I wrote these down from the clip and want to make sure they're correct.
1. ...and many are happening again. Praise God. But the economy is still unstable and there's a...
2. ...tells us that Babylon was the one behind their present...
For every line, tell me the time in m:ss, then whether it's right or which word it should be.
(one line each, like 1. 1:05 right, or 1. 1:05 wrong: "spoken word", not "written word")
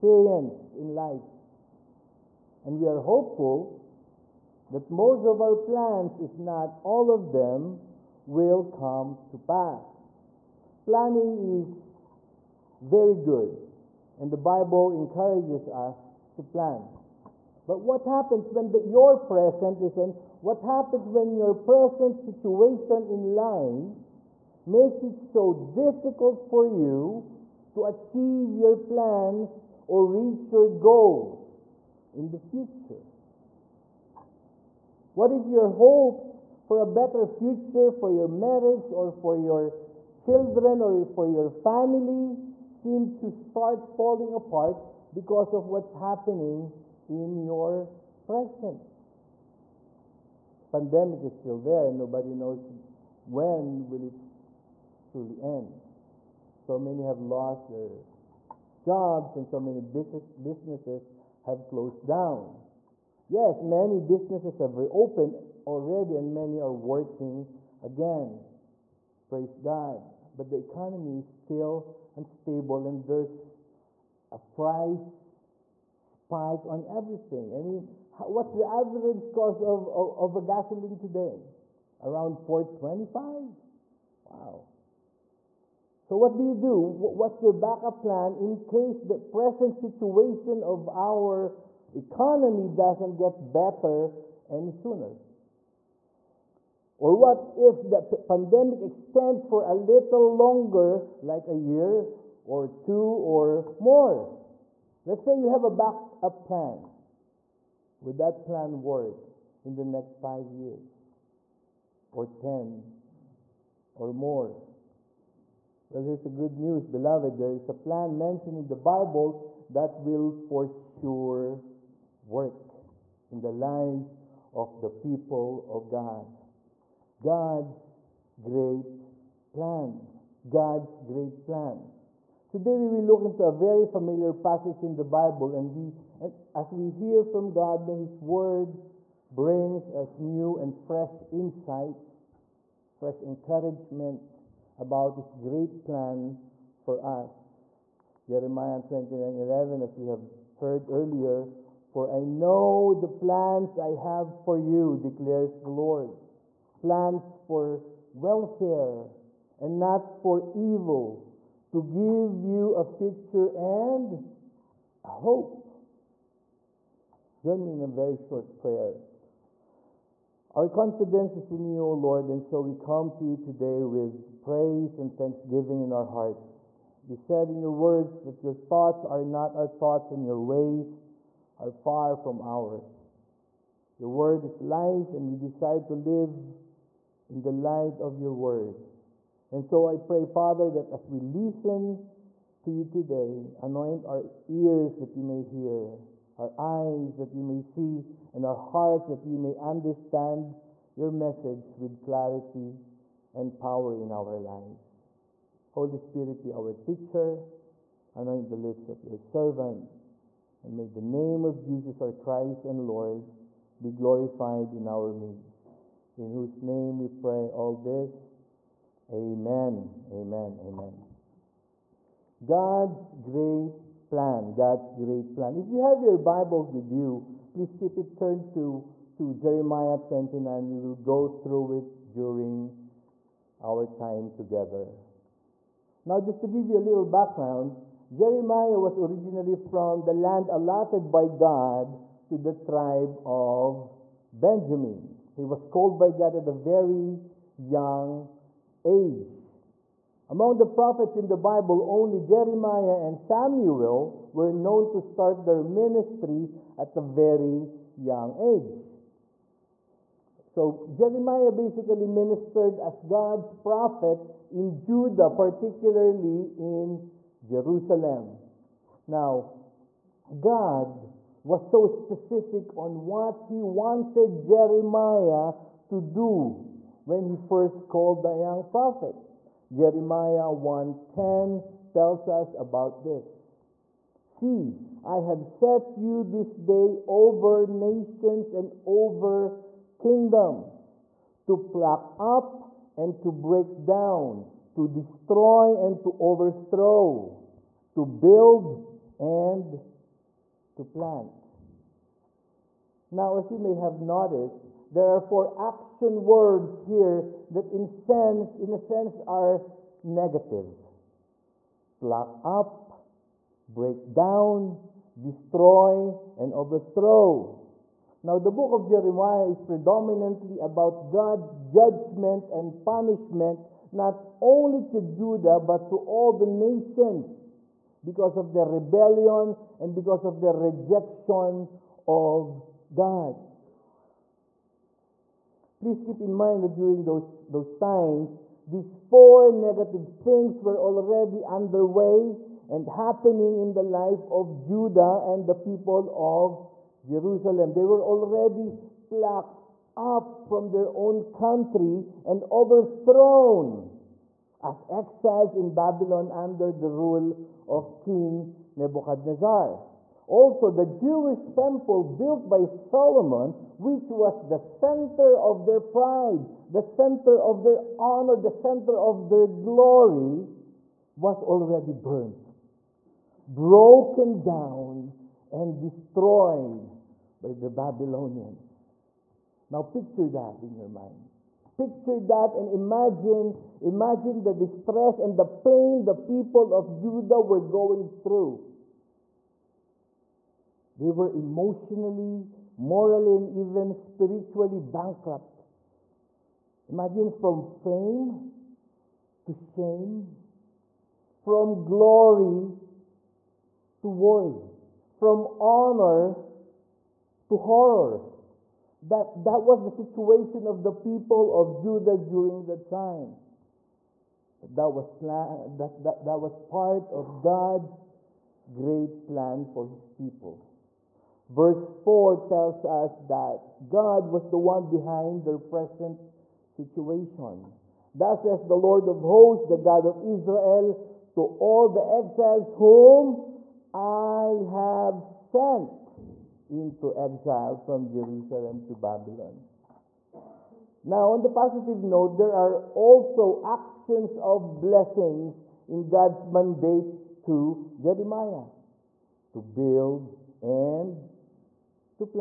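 1. 1:06 wrong: "working", not "happening"
2. 7:02 wrong: "God", not "Babylon".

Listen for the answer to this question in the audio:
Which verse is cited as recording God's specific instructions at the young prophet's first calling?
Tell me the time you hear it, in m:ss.
4:39.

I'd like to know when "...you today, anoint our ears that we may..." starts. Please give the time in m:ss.
3:12.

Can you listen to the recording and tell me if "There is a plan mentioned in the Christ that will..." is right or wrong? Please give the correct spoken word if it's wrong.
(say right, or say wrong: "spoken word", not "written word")
wrong: "Bible", not "Christ".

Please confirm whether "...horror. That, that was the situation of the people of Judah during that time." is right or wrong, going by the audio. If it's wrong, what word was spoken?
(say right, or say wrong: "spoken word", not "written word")
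right.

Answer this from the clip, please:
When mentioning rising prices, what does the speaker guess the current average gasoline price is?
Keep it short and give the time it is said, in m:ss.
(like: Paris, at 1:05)
425, at 1:22.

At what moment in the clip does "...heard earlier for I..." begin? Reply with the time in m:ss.
2:30.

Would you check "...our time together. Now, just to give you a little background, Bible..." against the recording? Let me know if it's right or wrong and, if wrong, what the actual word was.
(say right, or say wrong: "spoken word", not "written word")
wrong: "Jeremiah", not "Bible".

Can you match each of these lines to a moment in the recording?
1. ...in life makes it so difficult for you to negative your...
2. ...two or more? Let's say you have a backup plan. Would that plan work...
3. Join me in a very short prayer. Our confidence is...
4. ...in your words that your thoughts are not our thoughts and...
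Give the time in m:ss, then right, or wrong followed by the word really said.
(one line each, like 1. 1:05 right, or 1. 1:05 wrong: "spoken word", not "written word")
1. 0:23 wrong: "achieve", not "negative"
2. 1:42 right
3. 2:47 right
4. 2:57 right.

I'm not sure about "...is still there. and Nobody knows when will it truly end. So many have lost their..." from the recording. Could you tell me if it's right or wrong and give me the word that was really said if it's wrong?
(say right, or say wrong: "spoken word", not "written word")
right.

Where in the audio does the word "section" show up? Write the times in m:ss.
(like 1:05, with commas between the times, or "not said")
not said.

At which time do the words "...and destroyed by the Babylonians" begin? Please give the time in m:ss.
6:15.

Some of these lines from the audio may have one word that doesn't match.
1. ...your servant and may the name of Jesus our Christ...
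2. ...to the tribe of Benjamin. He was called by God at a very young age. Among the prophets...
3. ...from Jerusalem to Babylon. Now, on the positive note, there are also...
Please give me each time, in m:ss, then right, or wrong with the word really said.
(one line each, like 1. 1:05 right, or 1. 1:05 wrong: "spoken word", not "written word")
1. 3:29 right
2. 4:02 right
3. 7:17 right.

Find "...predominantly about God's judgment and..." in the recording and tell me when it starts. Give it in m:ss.
5:19.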